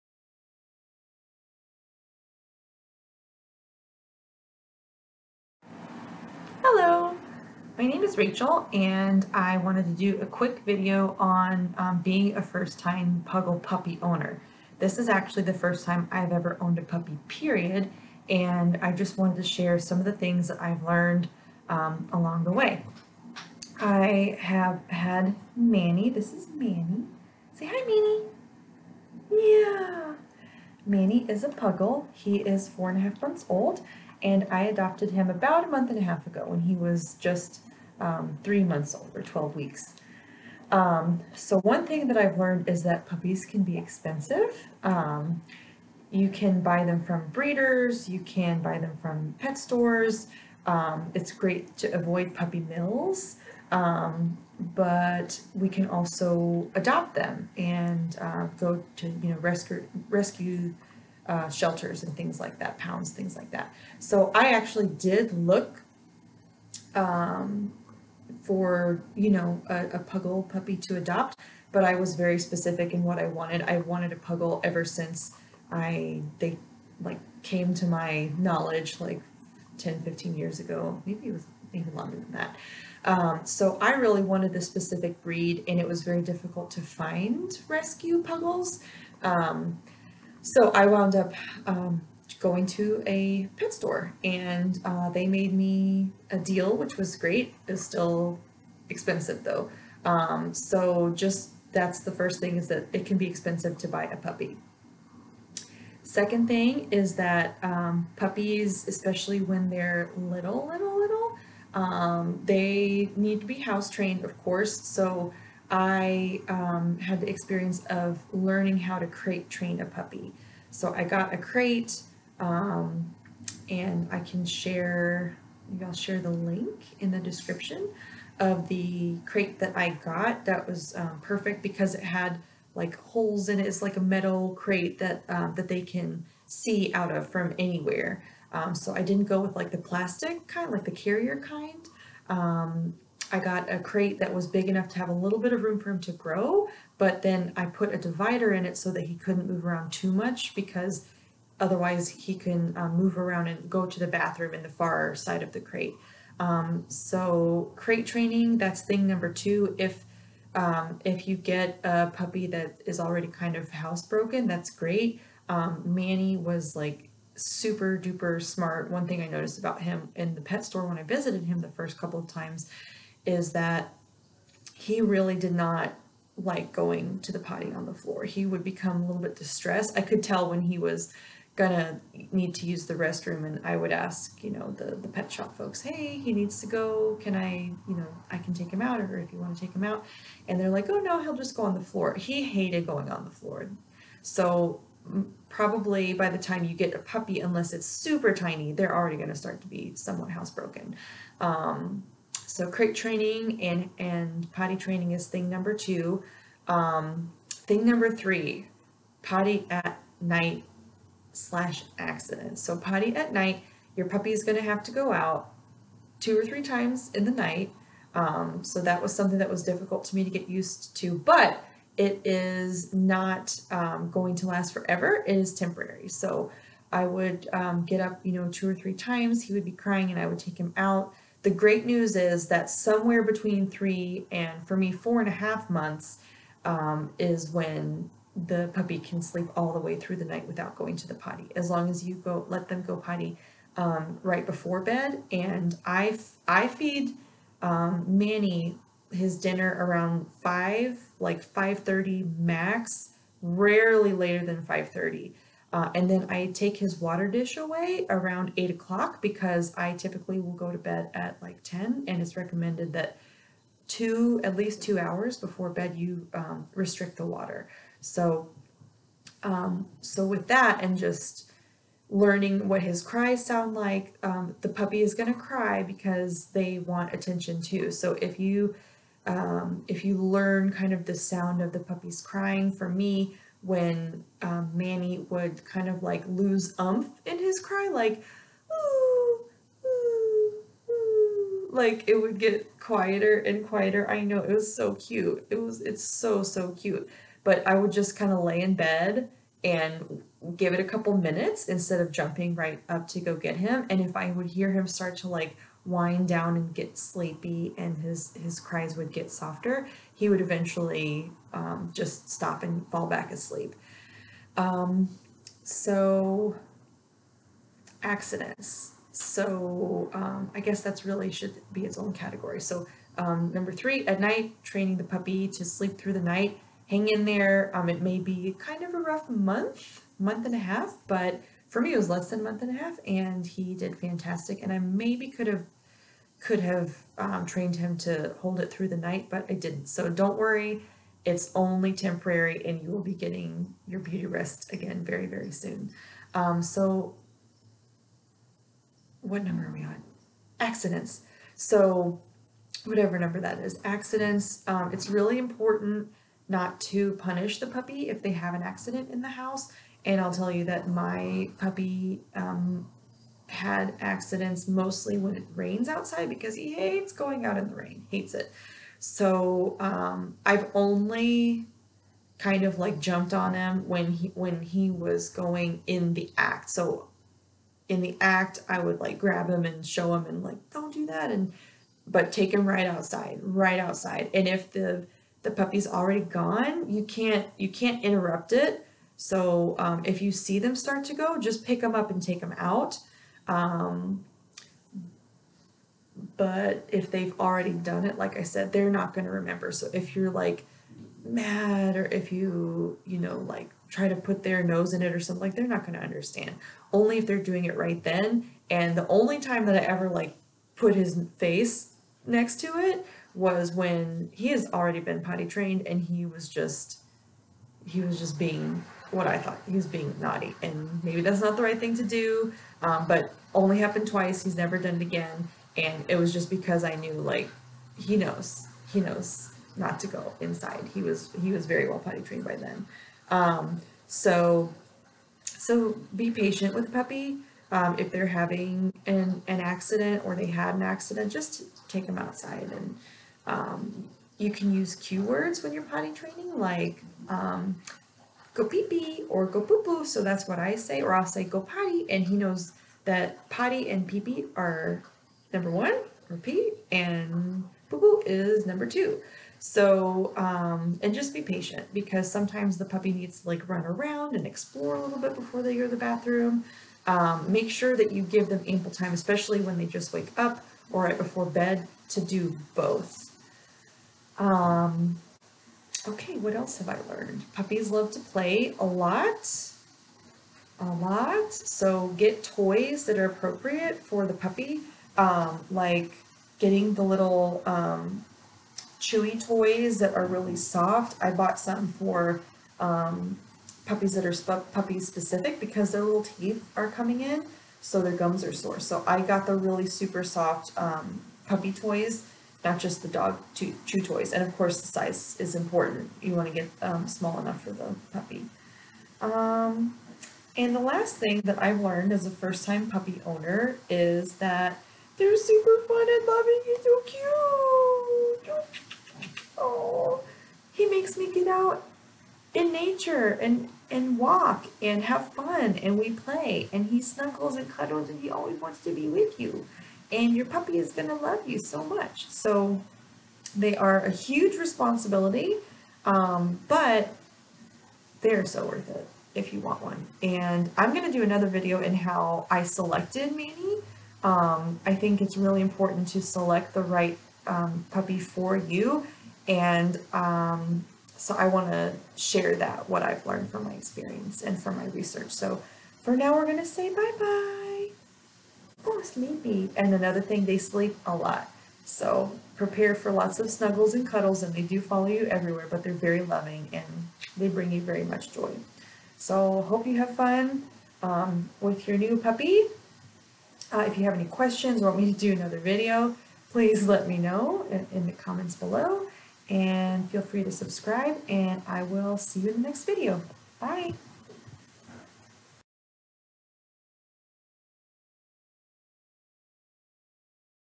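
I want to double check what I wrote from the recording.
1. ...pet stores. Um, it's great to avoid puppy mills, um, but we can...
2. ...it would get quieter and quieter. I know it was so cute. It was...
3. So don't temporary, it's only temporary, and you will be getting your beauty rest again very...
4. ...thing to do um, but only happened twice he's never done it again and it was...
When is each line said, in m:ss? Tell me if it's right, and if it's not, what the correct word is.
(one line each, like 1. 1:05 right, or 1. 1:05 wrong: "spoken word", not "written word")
1. 0:49 right
2. 4:52 right
3. 5:39 wrong: "worry", not "temporary"
4. 7:01 right.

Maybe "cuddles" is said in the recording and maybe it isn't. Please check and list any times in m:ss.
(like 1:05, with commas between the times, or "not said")
8:47, 9:24.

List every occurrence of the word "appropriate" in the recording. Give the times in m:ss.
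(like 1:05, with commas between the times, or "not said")
8:03.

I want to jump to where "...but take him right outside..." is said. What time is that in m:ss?
6:22.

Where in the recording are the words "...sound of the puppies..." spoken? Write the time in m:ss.
4:41.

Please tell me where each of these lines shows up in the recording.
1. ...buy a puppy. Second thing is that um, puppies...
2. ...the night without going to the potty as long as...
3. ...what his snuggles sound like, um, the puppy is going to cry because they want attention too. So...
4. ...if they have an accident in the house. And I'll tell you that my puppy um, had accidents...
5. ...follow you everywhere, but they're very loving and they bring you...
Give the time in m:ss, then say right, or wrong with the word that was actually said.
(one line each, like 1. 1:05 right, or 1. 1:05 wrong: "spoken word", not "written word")
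1. 1:43 right
2. 4:00 right
3. 4:32 wrong: "cries", not "snuggles"
4. 5:58 right
5. 9:24 right.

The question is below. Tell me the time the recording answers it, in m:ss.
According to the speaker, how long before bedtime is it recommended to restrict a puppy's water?
4:23.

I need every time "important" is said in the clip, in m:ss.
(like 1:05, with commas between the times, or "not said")
5:55, 8:25, 9:05.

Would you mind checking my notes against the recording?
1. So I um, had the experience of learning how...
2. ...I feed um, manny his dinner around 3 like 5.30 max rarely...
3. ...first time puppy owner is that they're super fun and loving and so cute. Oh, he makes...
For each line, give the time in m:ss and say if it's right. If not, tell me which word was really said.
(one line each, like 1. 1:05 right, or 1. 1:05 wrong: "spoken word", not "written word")
1. 1:54 right
2. 4:06 wrong: "5", not "3"
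3. 8:32 right.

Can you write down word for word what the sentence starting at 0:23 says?
I have had Manny, this is Manny.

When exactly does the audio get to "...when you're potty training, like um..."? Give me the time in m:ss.
7:25.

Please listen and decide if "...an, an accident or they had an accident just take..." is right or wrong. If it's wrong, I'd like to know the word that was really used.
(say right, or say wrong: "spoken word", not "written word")
right.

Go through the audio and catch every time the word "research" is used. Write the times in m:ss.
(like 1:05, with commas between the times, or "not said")
9:14.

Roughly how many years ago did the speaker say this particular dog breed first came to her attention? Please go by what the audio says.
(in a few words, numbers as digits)
10 to 15 years.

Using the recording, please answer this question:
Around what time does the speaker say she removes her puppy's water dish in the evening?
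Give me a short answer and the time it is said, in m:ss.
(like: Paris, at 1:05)
8 o'clock, at 4:18.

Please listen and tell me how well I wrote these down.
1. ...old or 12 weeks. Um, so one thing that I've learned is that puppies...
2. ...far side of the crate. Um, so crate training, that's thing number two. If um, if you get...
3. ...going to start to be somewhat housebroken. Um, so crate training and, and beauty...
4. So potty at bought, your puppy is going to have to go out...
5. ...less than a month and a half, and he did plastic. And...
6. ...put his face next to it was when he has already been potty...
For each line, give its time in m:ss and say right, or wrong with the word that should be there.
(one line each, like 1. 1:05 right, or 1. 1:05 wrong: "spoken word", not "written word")
1. 0:38 right
2. 2:34 right
3. 3:19 wrong: "potty", not "beauty"
4. 3:32 wrong: "night", not "bought"
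5. 5:32 wrong: "fantastic", not "plastic"
6. 6:50 right.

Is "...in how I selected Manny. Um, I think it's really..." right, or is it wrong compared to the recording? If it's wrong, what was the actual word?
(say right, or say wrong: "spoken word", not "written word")
right.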